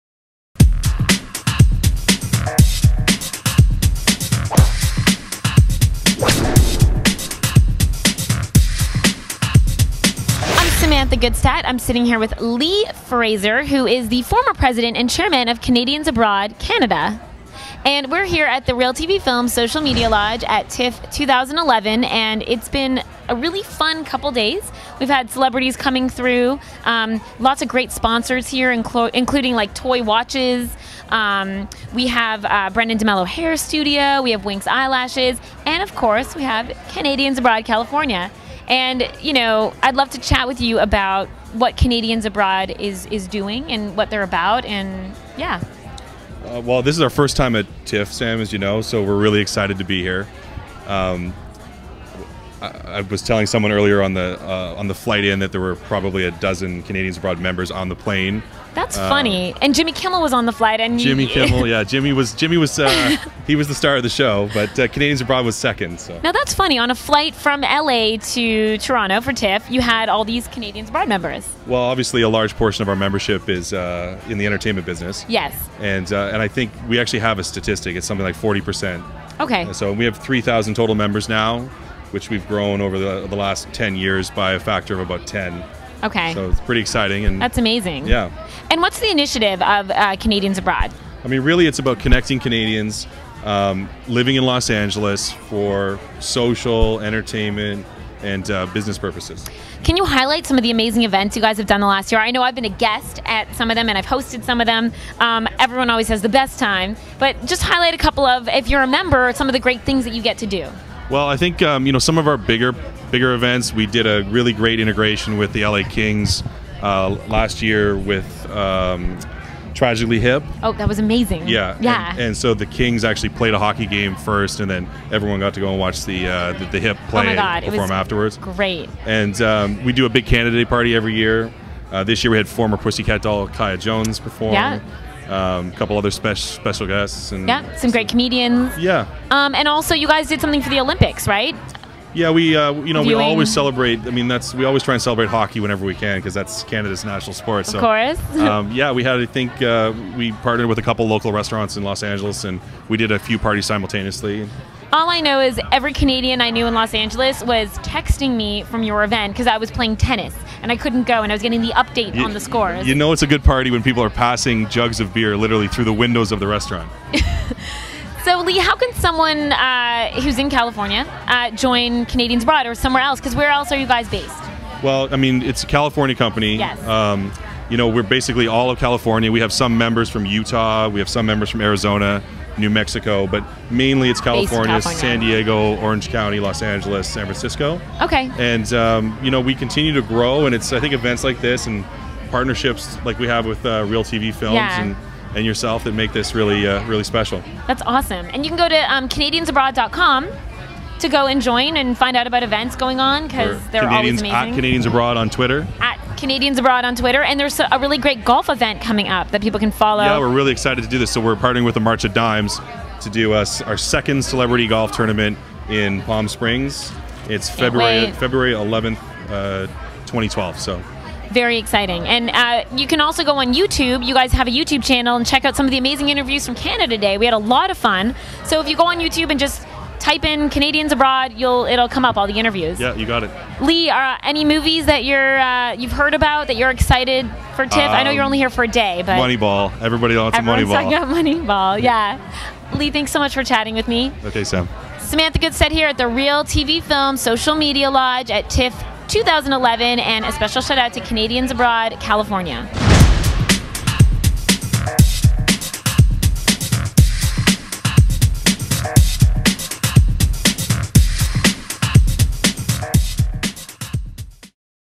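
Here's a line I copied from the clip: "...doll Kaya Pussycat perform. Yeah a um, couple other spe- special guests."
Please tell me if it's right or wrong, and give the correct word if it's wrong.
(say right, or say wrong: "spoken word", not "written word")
wrong: "Jones", not "Pussycat".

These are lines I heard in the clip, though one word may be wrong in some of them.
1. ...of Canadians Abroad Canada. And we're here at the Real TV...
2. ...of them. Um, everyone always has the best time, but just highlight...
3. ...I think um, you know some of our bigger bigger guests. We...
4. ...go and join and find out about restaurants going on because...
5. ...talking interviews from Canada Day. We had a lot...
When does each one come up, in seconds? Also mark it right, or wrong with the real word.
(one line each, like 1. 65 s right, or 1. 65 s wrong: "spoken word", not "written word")
1. 15 s right
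2. 104 s right
3. 111 s wrong: "events", not "guests"
4. 201 s wrong: "events", not "restaurants"
5. 225 s wrong: "amazing", not "talking".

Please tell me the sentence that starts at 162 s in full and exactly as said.
You know it's a good party when people are passing jugs of beer literally through the windows of the restaurant.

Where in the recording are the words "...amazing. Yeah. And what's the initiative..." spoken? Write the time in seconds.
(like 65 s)
87 s.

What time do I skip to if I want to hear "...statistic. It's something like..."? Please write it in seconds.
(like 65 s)
77 s.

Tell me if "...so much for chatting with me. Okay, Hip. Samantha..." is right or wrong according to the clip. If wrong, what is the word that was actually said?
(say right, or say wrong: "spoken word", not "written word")
wrong: "Sam", not "Hip".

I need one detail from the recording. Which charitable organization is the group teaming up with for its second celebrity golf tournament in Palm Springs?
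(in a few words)
March of Dimes.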